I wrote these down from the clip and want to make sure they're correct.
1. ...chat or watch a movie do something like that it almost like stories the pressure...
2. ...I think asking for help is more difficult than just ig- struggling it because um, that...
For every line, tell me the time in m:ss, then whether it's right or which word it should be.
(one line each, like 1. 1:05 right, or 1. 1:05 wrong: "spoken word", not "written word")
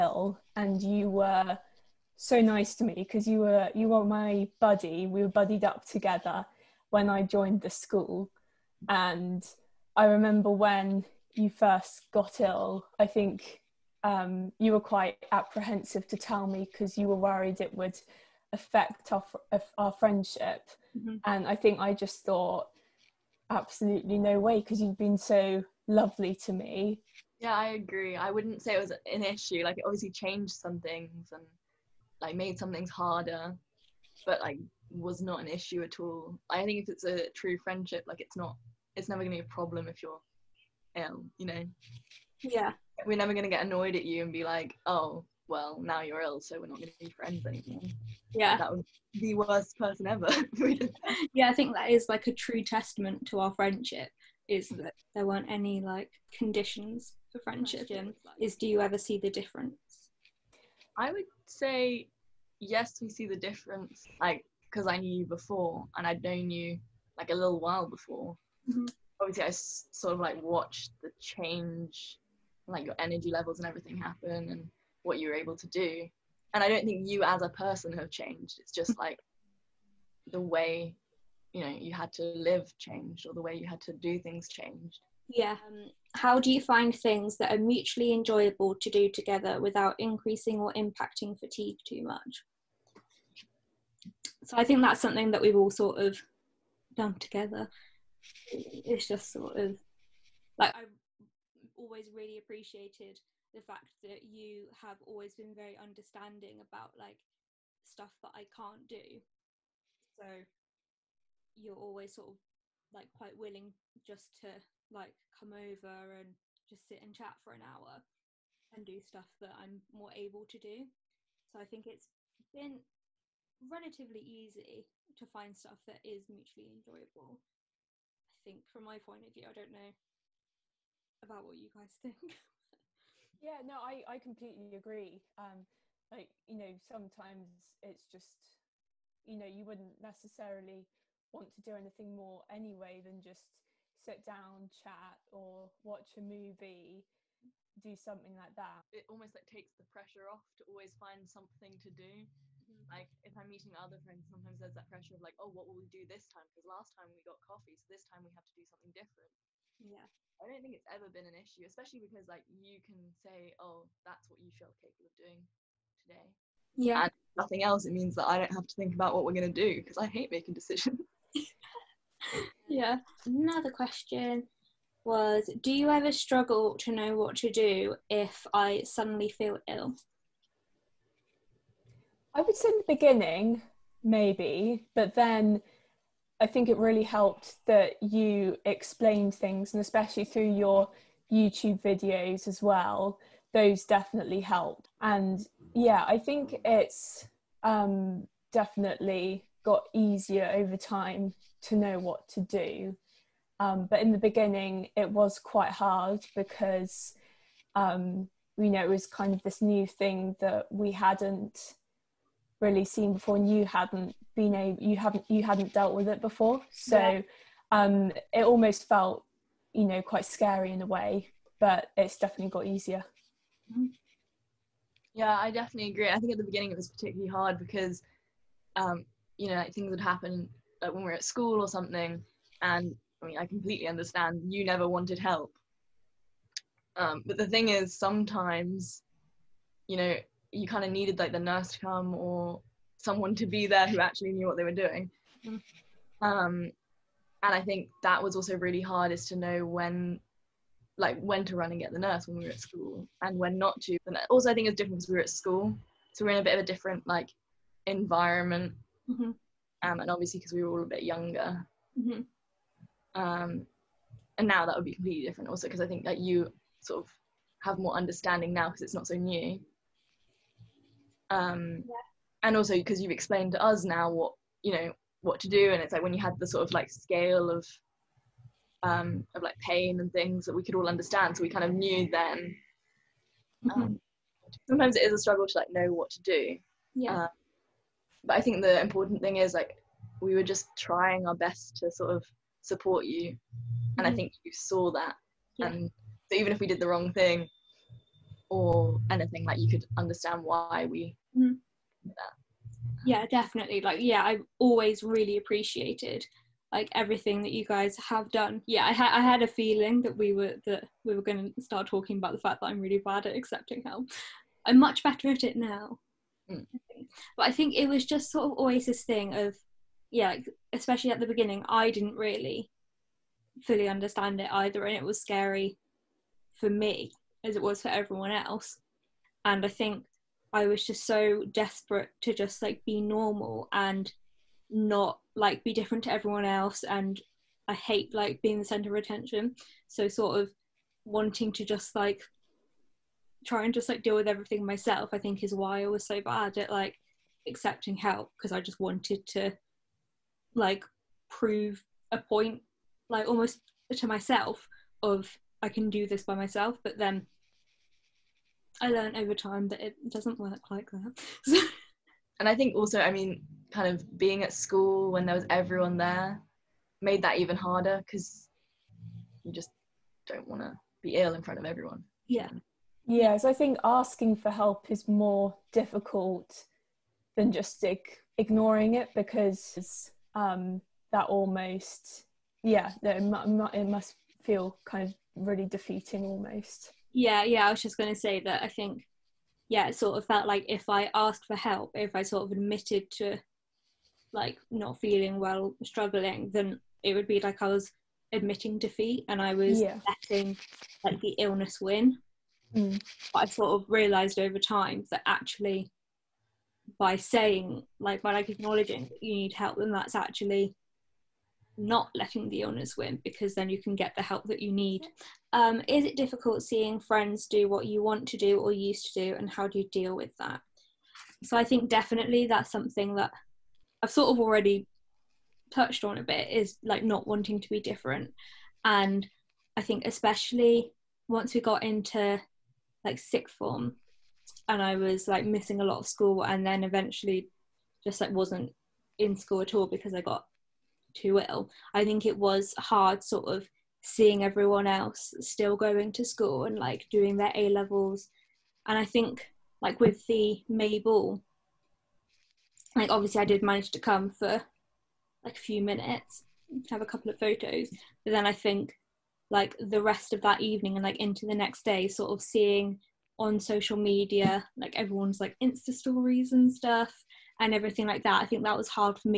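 1. 2:24 wrong: "takes", not "stories"
2. 6:13 wrong: "ignoring", not "struggling".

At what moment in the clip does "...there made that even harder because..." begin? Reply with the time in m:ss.
6:05.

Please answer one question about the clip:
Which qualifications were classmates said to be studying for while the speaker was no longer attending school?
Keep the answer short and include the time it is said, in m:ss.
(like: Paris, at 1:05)
A levels, at 7:27.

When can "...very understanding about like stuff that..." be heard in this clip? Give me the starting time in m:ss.
1:45.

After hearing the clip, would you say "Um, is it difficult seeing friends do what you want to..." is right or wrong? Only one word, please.
right.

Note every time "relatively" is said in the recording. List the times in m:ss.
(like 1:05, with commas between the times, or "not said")
2:03.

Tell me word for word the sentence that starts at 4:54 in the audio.
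i think you saw that yeah.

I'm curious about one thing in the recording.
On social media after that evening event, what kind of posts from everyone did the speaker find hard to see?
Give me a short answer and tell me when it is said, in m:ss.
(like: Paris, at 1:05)
Insta stories, at 7:45.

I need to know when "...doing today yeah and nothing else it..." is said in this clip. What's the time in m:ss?
2:45.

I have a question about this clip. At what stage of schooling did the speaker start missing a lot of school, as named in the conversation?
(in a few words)
sixth form.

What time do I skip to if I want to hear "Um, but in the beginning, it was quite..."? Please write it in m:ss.
3:23.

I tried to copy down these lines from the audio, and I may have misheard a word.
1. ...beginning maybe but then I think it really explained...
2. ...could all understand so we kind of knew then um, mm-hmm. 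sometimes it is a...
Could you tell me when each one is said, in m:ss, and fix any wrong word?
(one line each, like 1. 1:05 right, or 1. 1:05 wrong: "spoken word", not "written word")
1. 3:02 wrong: "helped", not "explained"
2. 4:40 right.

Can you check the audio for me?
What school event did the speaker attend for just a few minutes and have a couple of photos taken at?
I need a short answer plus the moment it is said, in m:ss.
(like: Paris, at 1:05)
May ball, at 7:30.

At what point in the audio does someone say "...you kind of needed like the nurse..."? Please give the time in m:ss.
4:00.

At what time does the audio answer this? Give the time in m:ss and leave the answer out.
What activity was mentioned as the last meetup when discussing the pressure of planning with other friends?
2:37.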